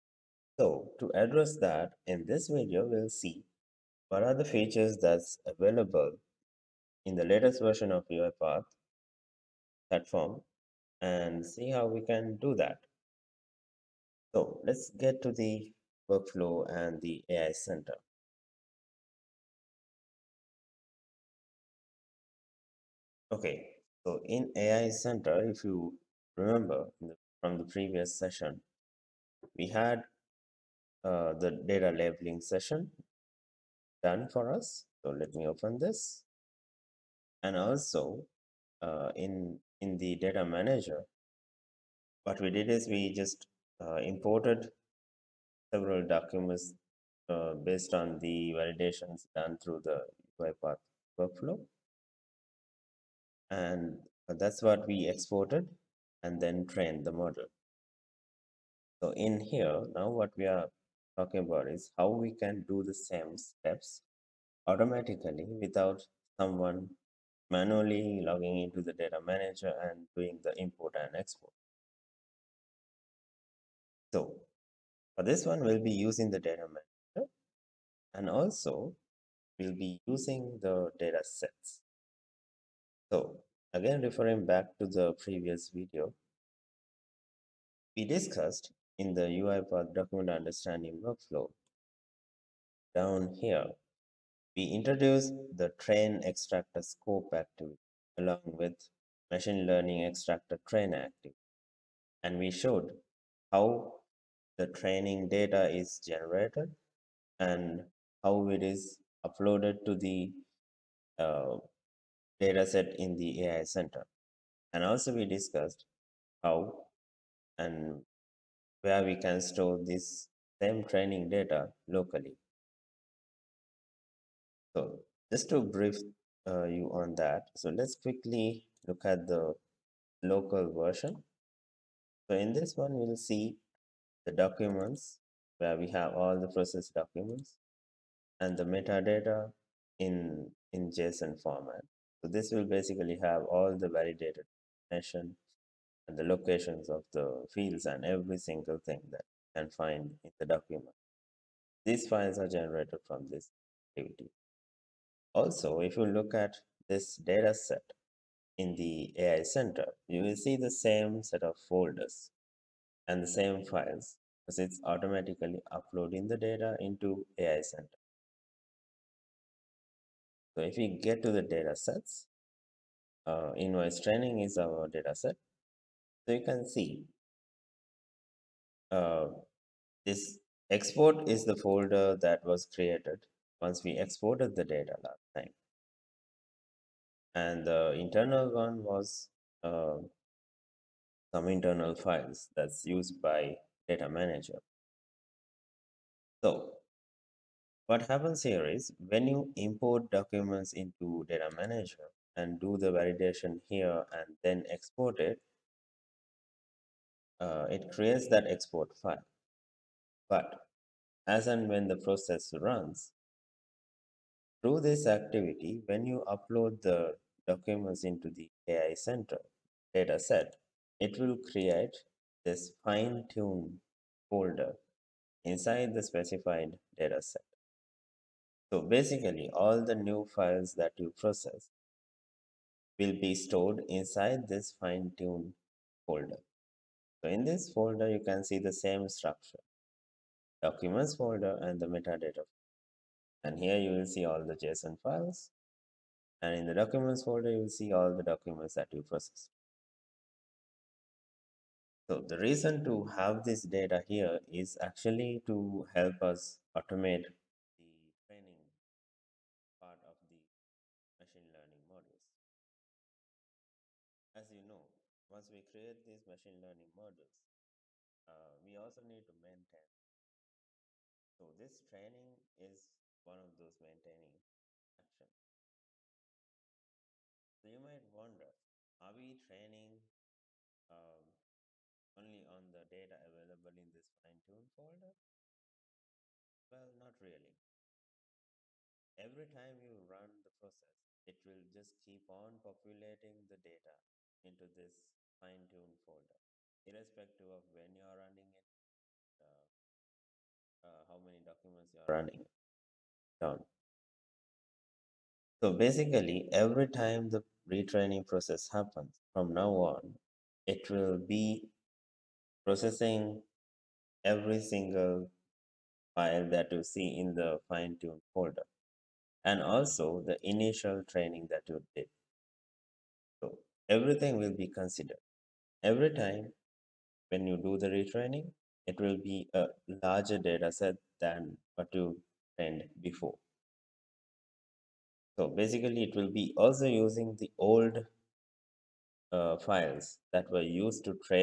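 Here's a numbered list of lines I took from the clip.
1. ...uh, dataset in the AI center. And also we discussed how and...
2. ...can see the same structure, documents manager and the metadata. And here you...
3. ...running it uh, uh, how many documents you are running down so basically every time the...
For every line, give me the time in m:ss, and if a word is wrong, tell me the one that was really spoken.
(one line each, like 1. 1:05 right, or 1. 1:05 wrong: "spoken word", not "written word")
1. 1:51 right
2. 3:58 wrong: "folder", not "manager"
3. 4:58 right.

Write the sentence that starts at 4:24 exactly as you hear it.
As you know, once we create these machine learning models, uh, we also need to maintain.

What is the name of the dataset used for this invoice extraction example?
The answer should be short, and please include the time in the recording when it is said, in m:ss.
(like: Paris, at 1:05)
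invoice training, at 2:53.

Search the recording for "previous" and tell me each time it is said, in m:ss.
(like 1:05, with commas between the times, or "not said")
0:27, 1:25.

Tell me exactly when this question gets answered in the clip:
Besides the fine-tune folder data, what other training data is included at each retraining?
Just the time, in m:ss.
5:20.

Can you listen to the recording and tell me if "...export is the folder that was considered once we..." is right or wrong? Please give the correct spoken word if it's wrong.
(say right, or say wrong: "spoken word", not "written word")
wrong: "created", not "considered".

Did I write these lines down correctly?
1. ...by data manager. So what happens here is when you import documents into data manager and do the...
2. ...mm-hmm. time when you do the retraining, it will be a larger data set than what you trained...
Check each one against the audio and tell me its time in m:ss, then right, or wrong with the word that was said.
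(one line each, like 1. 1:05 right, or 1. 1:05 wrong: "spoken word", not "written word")
1. 3:13 right
2. 5:26 right.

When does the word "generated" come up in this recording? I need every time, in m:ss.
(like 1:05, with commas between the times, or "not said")
1:46, 2:32.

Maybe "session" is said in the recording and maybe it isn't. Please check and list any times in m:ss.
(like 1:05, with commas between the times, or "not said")
0:28, 0:32.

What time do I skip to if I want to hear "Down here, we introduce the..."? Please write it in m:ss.
1:32.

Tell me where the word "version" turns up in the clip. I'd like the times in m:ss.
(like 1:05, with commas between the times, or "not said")
0:07, 2:10.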